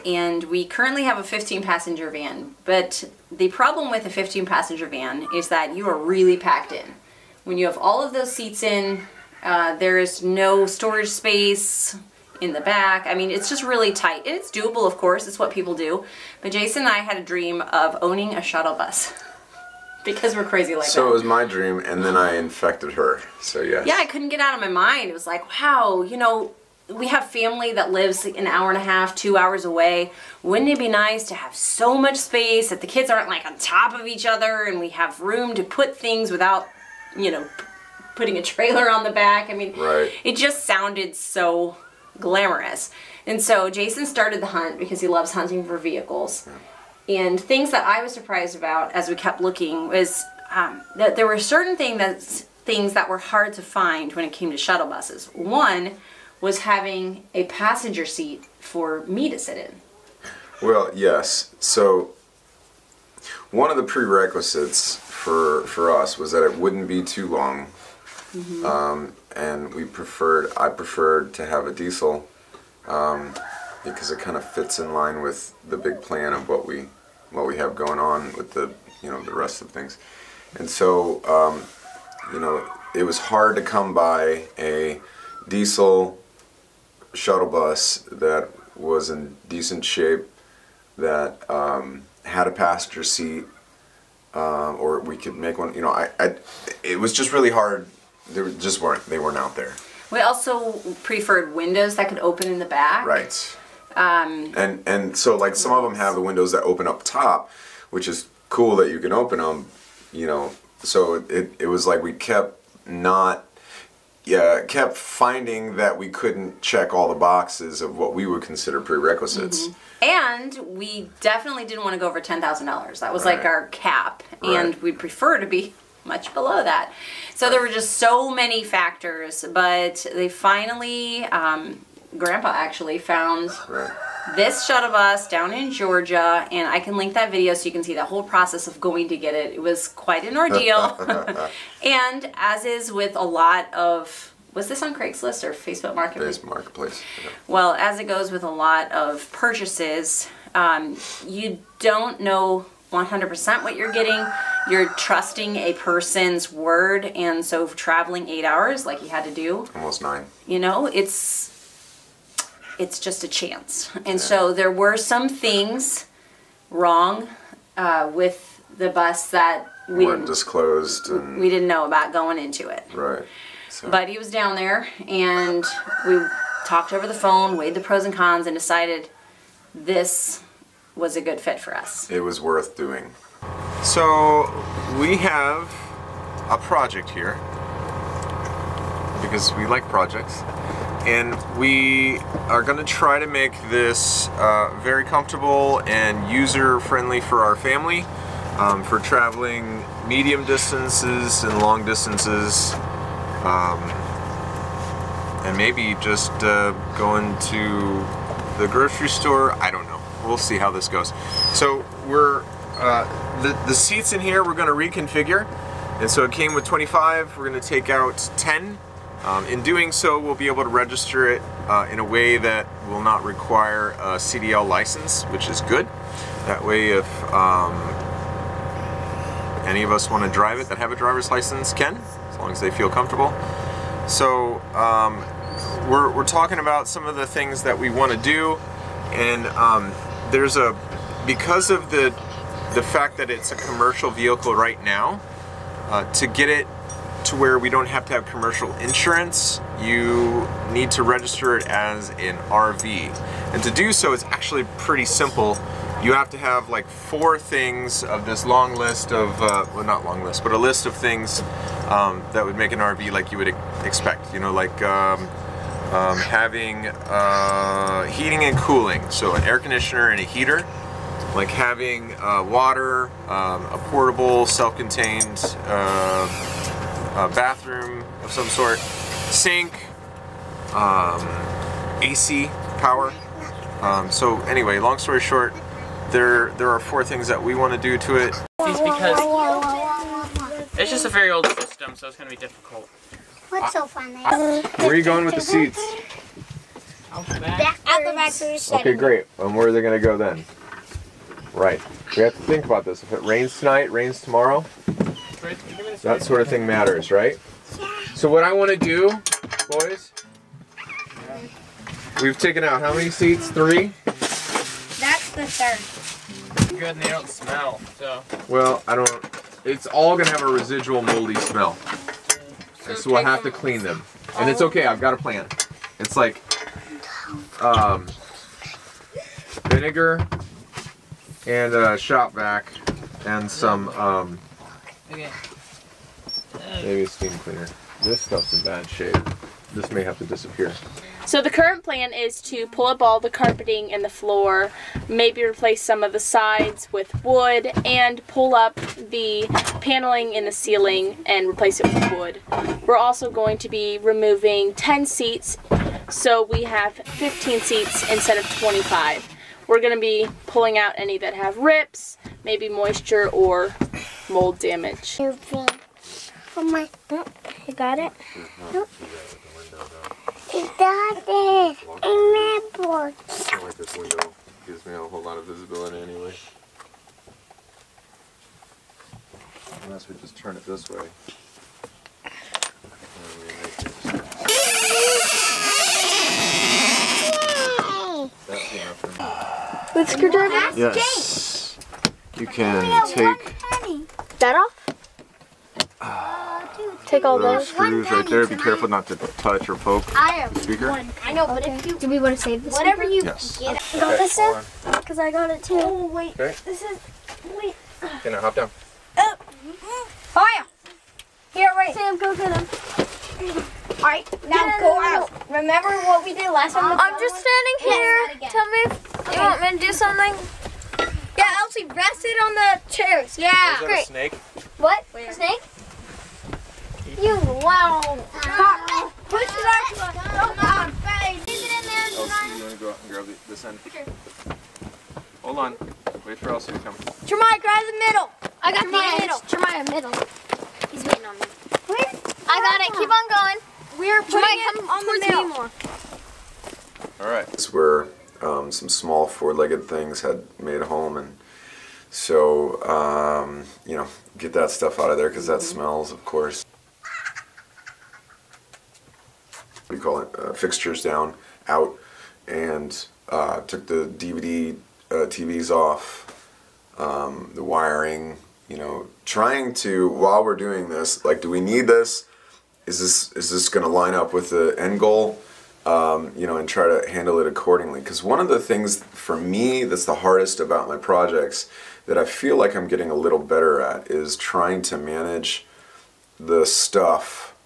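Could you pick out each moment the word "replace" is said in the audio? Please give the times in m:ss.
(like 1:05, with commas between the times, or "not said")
5:45, 5:51.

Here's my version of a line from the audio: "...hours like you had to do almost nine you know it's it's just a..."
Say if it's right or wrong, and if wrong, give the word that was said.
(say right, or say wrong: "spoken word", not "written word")
right.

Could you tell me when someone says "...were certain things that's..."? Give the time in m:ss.
0:51.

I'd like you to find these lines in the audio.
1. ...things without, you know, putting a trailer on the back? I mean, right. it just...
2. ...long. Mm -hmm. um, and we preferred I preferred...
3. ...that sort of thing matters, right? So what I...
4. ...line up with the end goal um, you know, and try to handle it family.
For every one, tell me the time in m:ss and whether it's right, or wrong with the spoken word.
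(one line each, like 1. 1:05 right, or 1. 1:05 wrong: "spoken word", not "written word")
1. 0:35 right
2. 1:07 right
3. 5:06 right
4. 7:53 wrong: "accordingly", not "family".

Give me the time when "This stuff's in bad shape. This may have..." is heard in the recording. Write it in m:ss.
5:38.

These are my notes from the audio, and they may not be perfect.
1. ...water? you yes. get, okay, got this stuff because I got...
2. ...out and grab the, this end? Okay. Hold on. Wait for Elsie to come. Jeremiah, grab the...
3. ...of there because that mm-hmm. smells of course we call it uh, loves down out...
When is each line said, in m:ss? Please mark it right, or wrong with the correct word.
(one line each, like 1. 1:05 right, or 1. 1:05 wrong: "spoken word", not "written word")
1. 6:43 wrong: "speaker", not "water"
2. 7:12 right
3. 7:35 wrong: "fixtures", not "loves".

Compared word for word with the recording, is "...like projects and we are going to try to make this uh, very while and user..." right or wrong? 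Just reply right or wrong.
wrong.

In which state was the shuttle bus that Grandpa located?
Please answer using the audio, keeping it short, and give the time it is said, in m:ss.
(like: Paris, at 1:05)
Georgia, at 2:15.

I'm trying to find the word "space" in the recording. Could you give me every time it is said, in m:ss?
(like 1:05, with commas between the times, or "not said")
0:11, 0:32.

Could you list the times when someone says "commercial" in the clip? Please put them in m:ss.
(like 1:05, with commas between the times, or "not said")
4:03, 4:08.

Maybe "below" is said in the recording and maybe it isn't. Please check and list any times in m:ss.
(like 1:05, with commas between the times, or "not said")
2:06.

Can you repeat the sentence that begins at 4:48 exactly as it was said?
It's because it's just a very old system, so it's going to be difficult.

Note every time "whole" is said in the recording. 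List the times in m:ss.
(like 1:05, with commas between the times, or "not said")
2:18, 6:14.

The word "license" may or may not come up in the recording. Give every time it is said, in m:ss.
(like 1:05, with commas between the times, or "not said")
3:44, 3:51.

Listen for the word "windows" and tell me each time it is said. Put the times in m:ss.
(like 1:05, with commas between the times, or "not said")
1:41, 1:46, 6:13.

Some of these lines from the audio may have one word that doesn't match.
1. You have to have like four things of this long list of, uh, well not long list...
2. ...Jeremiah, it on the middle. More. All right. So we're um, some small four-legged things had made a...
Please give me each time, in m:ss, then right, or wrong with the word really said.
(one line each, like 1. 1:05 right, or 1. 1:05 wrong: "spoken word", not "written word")
1. 4:16 right
2. 7:24 right.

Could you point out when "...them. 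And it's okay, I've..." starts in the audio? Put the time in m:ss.
5:23.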